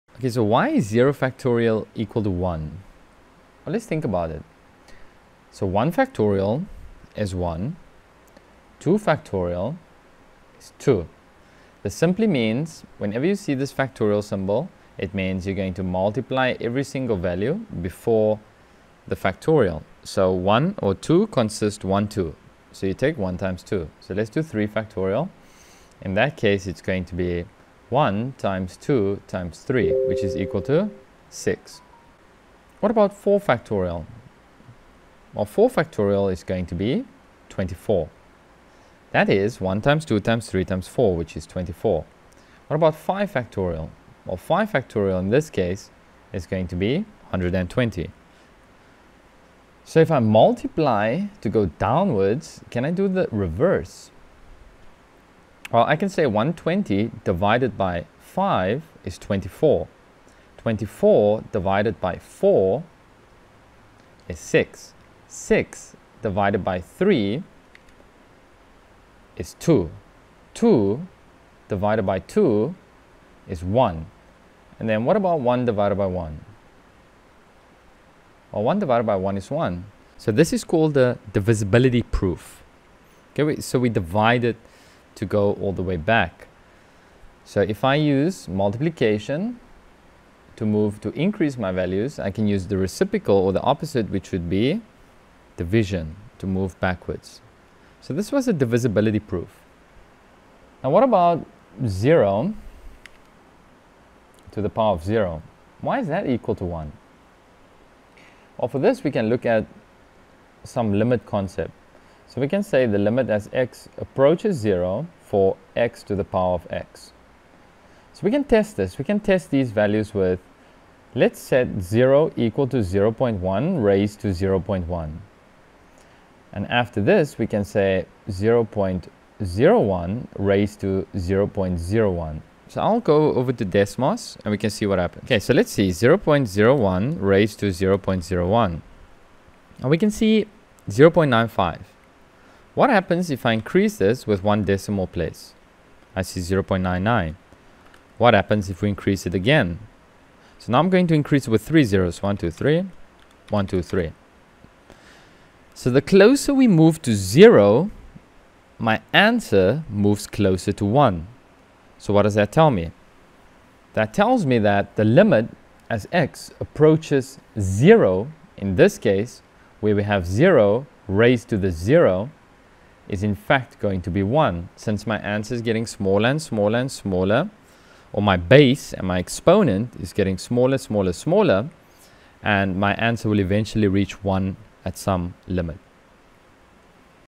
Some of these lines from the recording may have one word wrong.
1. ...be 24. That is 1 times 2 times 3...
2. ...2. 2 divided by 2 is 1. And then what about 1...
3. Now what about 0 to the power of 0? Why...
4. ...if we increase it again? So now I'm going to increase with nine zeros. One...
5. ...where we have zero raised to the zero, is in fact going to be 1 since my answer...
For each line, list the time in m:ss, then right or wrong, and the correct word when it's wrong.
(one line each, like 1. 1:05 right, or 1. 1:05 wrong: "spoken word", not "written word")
1. 0:36 right
2. 1:09 right
3. 1:40 right
4. 2:28 wrong: "three", not "nine"
5. 2:49 right.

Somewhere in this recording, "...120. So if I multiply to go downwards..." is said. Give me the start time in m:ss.
0:47.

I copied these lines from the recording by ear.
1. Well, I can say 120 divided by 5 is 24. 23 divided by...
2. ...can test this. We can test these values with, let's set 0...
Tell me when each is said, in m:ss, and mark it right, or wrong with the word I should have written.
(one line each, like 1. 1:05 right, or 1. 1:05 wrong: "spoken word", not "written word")
1. 0:55 wrong: "24", not "23"
2. 1:58 right.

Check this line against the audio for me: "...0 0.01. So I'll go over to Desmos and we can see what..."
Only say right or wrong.
right.